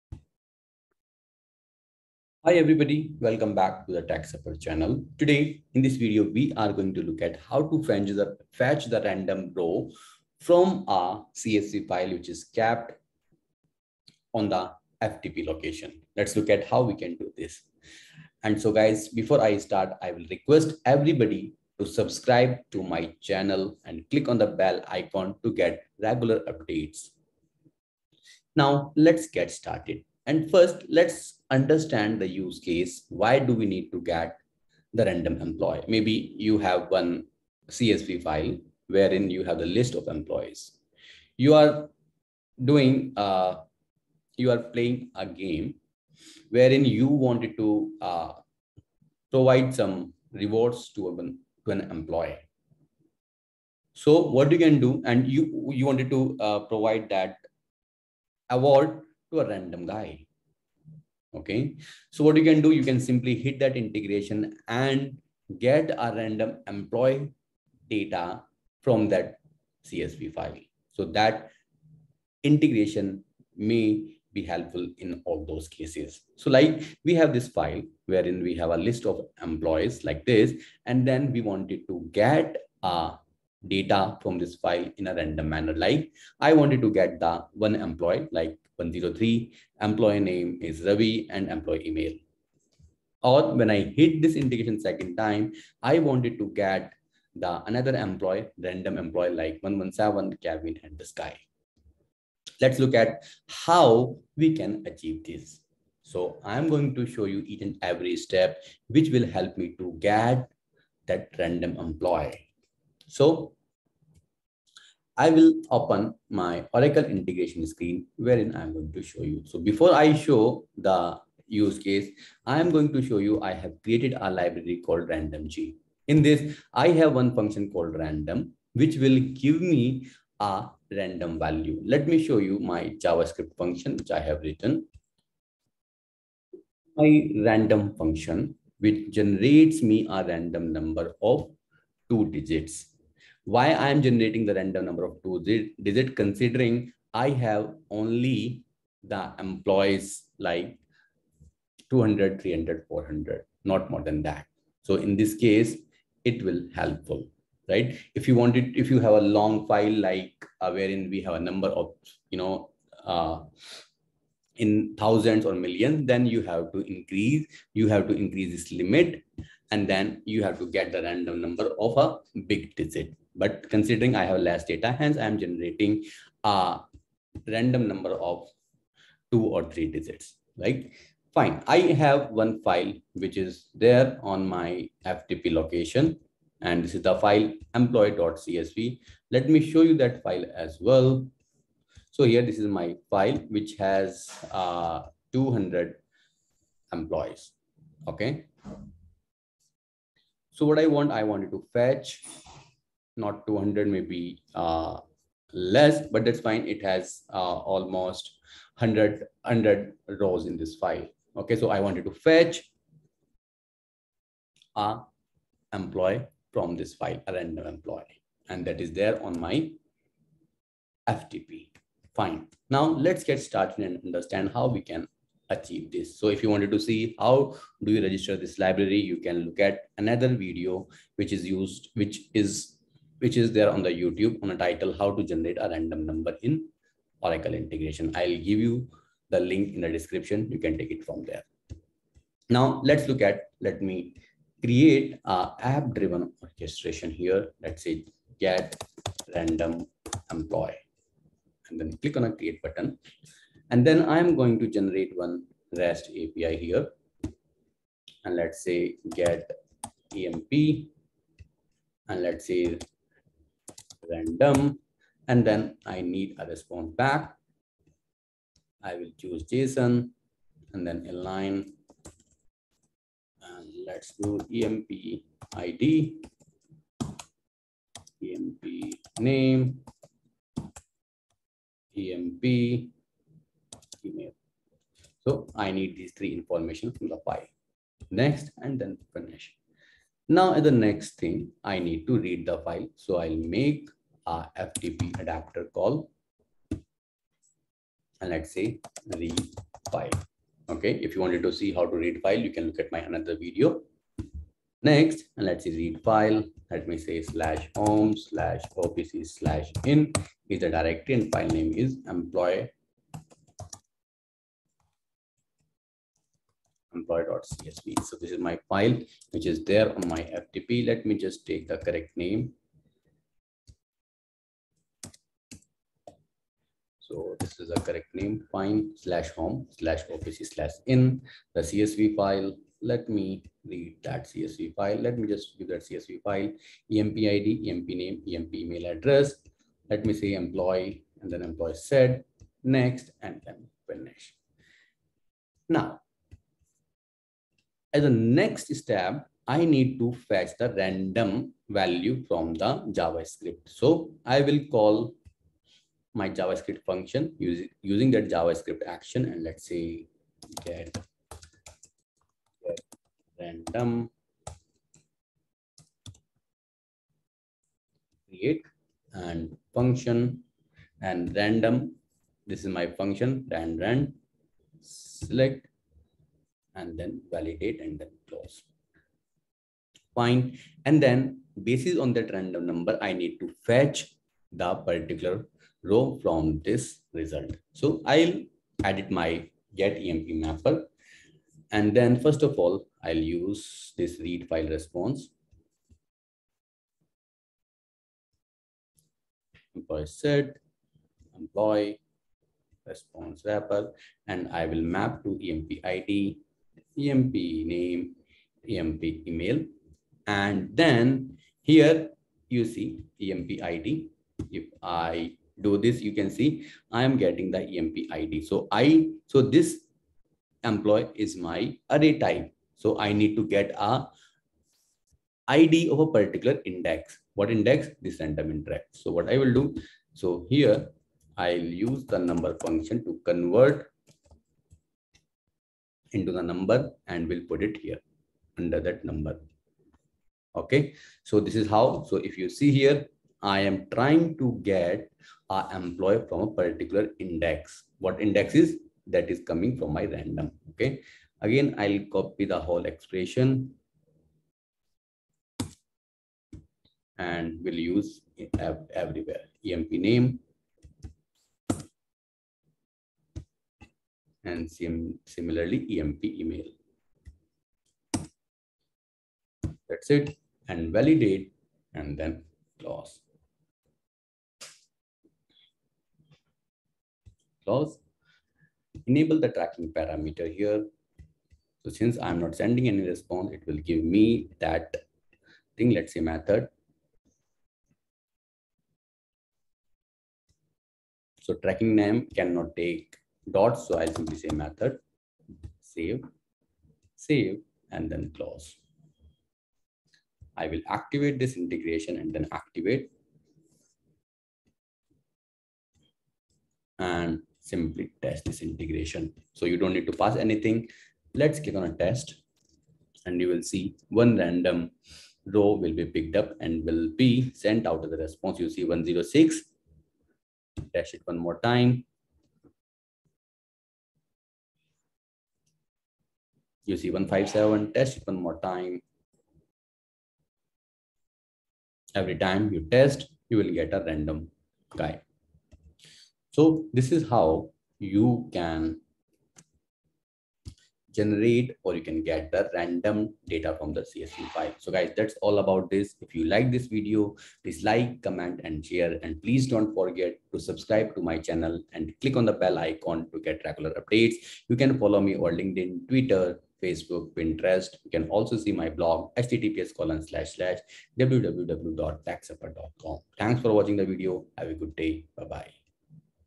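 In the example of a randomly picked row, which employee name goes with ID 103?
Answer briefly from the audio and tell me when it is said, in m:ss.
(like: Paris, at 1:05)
Ravi, at 1:30.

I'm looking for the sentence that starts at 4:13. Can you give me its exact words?
And then I'm going to generate one REST API here.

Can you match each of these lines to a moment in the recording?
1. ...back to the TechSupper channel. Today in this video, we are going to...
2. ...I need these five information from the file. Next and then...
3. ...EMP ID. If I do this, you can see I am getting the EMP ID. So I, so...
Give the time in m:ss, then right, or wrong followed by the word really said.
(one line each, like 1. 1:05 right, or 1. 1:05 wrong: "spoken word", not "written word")
1. 0:03 right
2. 4:45 wrong: "three", not "five"
3. 6:53 right.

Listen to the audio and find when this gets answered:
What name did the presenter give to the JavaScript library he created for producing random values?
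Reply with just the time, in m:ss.
2:05.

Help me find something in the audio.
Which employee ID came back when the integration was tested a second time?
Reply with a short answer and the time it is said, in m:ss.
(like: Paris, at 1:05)
157, at 8:47.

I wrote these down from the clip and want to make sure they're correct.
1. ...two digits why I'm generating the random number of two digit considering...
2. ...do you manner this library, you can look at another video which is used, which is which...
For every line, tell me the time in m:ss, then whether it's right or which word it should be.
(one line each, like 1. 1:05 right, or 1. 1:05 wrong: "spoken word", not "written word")
1. 2:22 right
2. 3:47 wrong: "register", not "manner".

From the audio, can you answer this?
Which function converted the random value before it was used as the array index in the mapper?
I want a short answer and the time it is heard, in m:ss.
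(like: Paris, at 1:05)
number function, at 7:12.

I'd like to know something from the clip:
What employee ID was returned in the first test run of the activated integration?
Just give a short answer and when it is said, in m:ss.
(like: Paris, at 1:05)
106, at 8:38.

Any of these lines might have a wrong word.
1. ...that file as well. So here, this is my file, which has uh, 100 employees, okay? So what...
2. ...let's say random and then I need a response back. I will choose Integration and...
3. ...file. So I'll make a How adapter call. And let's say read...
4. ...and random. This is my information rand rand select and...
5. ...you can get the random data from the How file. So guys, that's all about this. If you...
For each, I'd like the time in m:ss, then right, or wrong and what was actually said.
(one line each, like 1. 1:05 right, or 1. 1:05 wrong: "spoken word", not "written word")
1. 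3:09 wrong: "200", not "100"
2. 4:22 wrong: "JSON", not "Integration"
3. 4:52 wrong: "FTP", not "How"
4. 6:11 wrong: "function", not "information"
5. 9:01 wrong: "CSV", not "How".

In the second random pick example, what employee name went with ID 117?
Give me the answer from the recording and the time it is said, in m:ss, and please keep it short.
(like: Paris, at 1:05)
Kevin, at 1:40.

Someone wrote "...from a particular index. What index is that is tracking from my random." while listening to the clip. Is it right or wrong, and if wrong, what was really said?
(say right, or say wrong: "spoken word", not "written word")
wrong: "coming", not "tracking".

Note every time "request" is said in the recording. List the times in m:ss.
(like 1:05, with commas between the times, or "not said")
0:20.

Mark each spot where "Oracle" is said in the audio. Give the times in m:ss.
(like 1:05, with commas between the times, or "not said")
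1:56, 3:57.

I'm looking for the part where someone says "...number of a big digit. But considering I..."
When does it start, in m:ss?
2:51.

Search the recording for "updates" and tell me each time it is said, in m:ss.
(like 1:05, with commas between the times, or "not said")
0:26, 9:13.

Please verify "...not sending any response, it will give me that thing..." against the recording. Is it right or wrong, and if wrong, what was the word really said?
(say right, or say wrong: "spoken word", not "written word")
right.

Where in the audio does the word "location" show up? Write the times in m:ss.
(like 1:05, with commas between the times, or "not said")
0:15, 3:05.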